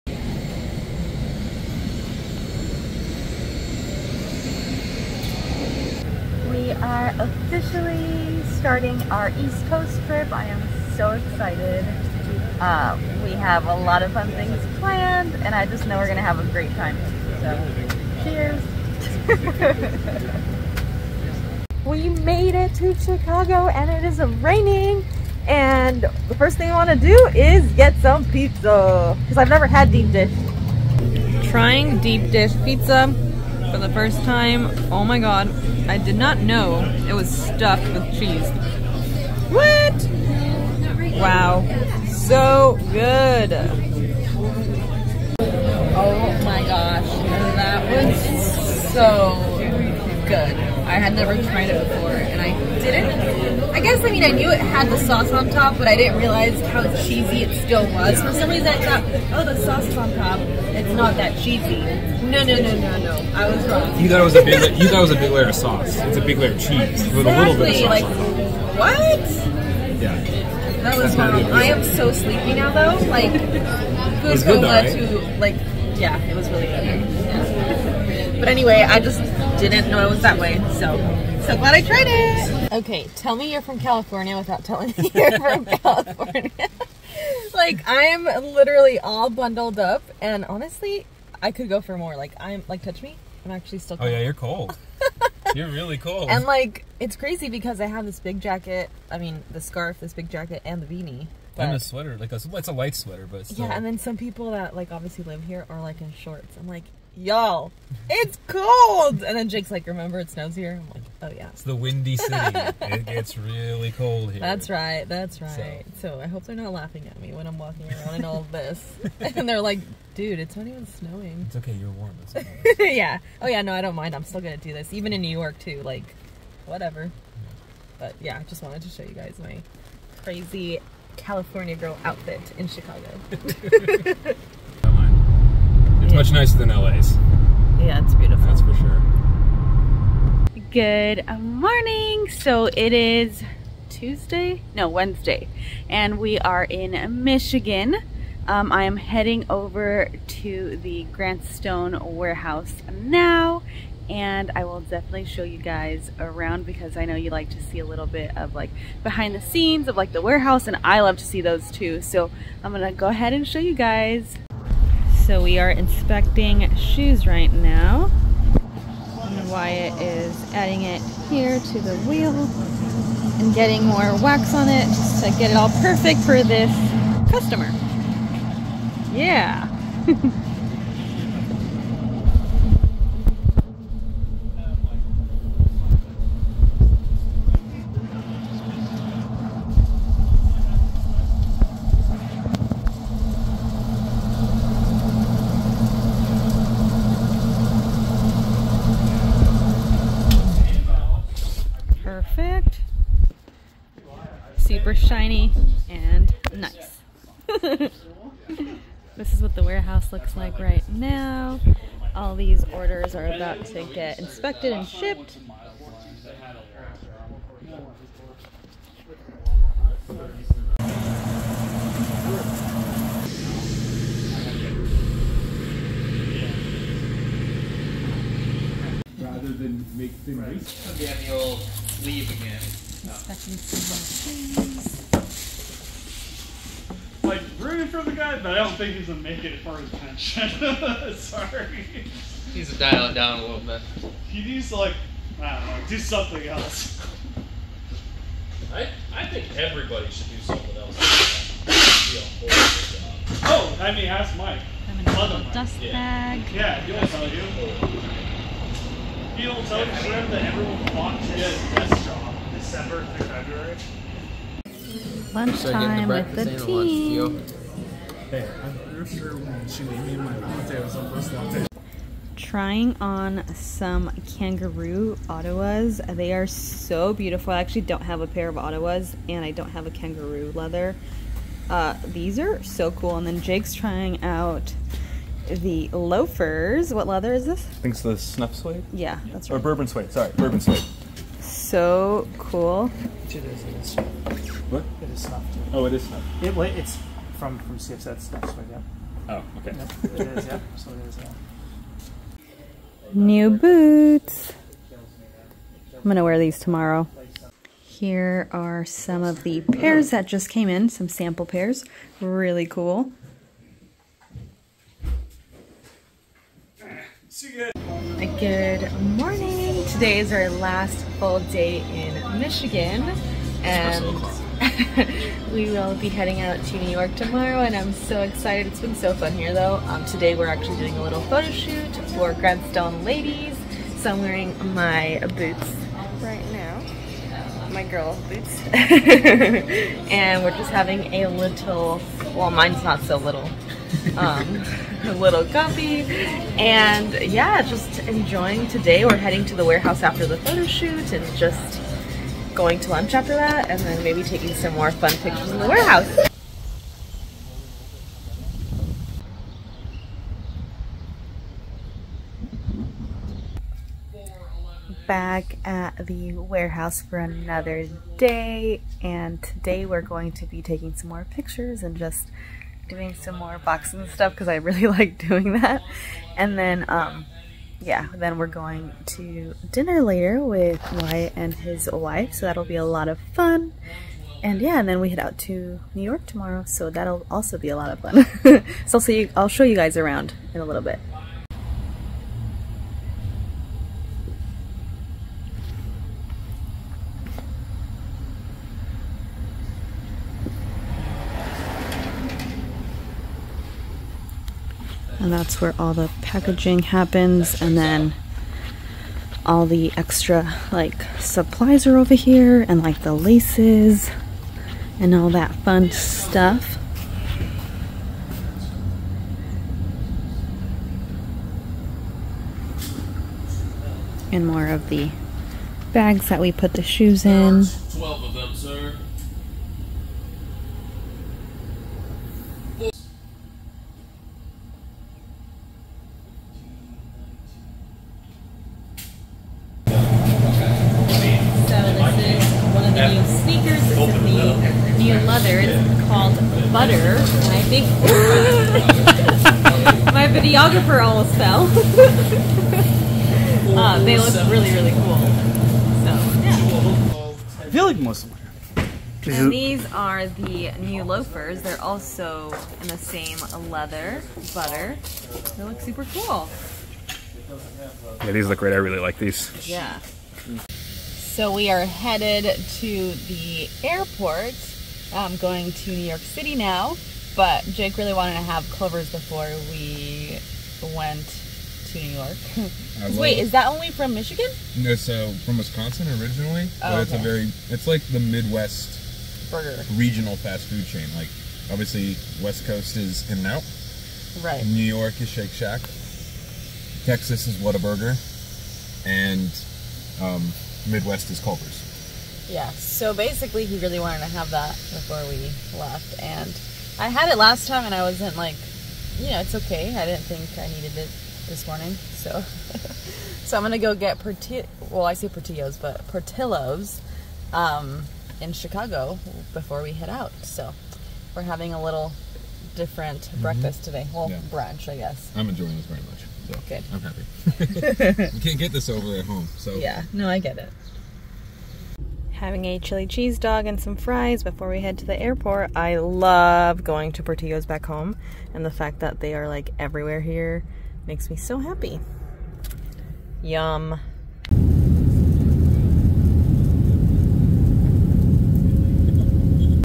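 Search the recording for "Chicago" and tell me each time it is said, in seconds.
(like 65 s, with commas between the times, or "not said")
22 s, 132 s, 518 s.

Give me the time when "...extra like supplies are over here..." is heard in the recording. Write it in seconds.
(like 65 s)
409 s.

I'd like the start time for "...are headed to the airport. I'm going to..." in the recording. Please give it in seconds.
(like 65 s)
471 s.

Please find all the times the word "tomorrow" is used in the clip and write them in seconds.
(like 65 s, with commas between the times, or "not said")
306 s, 327 s, 386 s.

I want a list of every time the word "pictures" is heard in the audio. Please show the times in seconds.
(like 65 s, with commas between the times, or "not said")
355 s, 371 s.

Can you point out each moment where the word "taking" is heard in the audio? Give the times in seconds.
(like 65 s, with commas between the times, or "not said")
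354 s, 370 s.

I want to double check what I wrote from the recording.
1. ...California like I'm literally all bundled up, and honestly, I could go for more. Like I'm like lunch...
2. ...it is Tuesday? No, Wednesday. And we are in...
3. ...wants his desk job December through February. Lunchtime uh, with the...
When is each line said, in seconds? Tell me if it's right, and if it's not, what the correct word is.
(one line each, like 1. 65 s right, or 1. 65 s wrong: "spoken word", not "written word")
1. 85 s wrong: "touch", not "lunch"
2. 142 s right
3. 260 s right.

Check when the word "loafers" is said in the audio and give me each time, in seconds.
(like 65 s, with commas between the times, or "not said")
285 s, 461 s.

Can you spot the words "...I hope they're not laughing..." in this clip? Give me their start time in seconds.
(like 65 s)
116 s.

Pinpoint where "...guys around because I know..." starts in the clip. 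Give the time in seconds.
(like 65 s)
155 s.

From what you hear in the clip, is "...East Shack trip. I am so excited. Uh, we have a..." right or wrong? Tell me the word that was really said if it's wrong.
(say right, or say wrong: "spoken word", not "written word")
wrong: "Coast", not "Shack".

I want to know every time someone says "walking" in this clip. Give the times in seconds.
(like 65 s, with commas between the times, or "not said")
117 s.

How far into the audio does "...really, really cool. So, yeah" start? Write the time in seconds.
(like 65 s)
454 s.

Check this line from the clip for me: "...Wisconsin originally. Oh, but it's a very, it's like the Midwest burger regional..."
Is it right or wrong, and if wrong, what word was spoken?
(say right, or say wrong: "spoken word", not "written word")
right.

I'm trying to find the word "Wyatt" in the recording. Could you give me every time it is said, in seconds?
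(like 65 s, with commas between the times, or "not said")
169 s, 380 s.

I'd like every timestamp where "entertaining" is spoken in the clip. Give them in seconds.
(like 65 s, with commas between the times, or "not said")
not said.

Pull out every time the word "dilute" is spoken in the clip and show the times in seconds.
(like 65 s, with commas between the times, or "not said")
not said.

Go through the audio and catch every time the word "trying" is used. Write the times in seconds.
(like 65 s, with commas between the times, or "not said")
31 s, 272 s, 283 s.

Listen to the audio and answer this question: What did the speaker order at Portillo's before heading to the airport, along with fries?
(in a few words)
Chili cheese dog.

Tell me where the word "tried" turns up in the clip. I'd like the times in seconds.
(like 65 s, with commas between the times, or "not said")
51 s, 81 s.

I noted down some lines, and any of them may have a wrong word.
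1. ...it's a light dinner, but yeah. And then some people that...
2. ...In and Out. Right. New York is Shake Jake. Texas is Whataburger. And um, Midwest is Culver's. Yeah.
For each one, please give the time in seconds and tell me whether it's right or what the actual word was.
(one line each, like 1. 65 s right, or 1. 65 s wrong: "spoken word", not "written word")
1. 102 s wrong: "sweater", not "dinner"
2. 493 s wrong: "Shack", not "Jake".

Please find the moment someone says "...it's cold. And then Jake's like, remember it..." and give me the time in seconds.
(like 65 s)
108 s.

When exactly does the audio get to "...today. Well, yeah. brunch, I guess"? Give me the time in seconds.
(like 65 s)
523 s.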